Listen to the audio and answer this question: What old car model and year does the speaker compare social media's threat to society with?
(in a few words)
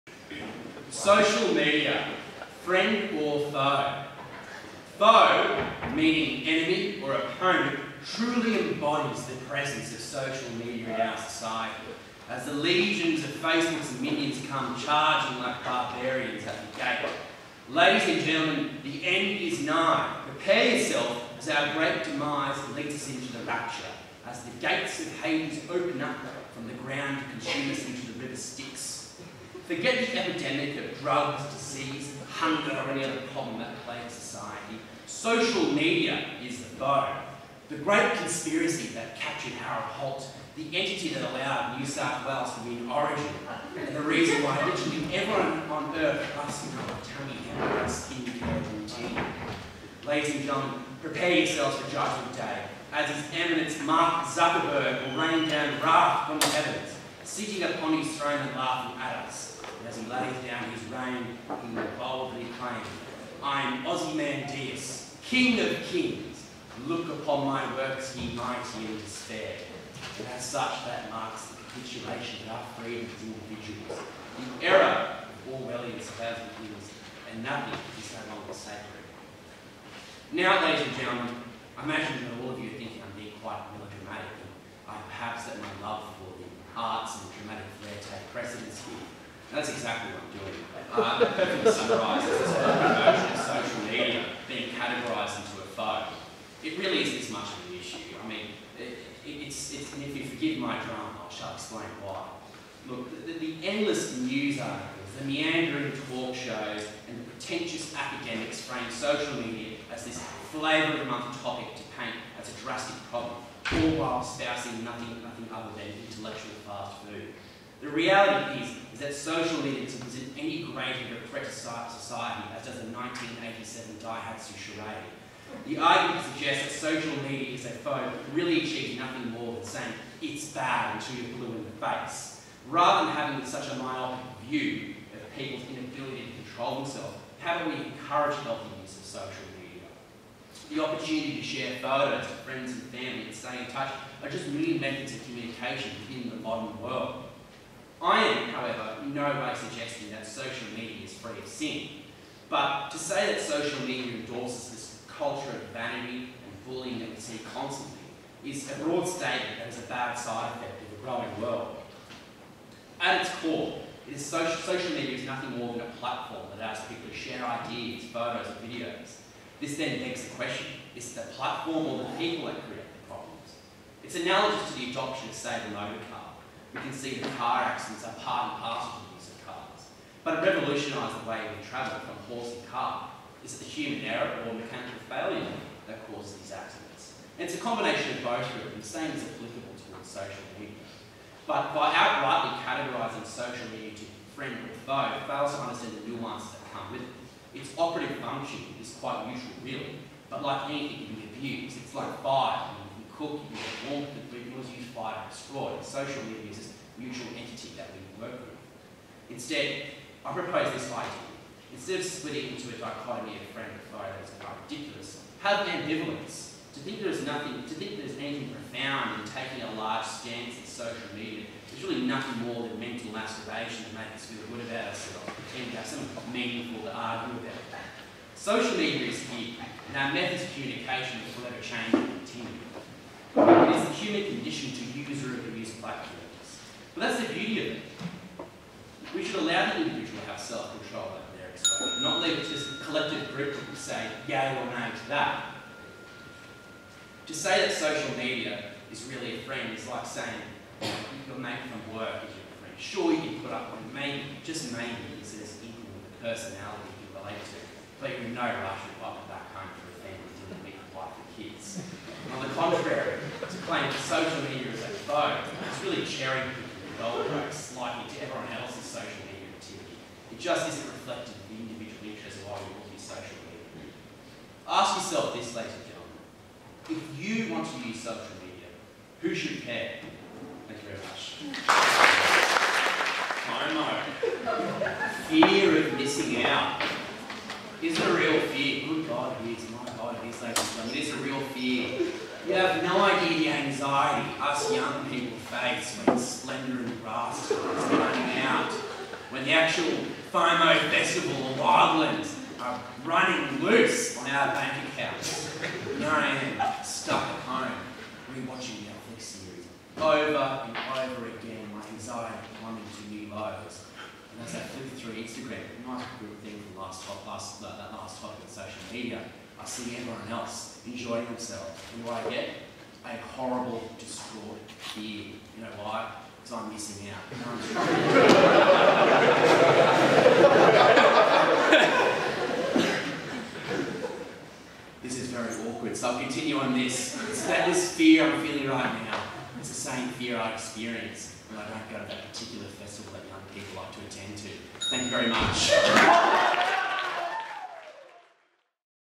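1987 Daihatsu Charade.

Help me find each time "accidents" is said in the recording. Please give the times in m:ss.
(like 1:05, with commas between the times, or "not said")
2:57, 3:06.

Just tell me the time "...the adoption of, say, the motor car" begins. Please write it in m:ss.
2:54.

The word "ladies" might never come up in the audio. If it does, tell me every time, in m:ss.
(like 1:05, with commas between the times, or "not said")
0:17, 0:50, 1:20, 4:35, 4:50.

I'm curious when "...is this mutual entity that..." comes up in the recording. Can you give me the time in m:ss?
3:26.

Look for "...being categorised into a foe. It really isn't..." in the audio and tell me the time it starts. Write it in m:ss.
1:34.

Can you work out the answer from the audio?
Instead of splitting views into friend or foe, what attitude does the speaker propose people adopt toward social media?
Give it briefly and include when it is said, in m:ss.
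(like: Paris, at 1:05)
ambivalence, at 3:35.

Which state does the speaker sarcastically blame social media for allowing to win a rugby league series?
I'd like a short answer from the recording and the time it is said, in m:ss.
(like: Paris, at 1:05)
New South Wales, at 0:41.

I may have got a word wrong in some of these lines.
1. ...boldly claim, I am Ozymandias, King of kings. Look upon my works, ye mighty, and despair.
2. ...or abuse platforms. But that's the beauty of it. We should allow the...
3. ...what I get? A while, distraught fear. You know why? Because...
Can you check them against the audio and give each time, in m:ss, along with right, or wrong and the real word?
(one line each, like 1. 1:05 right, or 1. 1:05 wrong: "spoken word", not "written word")
1. 1:01 right
2. 3:55 right
3. 5:22 wrong: "horrible", not "while".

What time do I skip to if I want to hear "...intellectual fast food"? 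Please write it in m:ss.
1:56.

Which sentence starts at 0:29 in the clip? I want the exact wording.
Forget the epidemic of drugs, disease, hunger, or any other problem that plagues society.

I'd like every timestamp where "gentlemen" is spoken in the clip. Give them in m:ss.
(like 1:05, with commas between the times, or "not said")
0:18, 0:50, 1:20, 4:35, 4:50.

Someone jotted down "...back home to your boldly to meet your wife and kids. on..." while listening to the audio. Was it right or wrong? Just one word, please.
wrong.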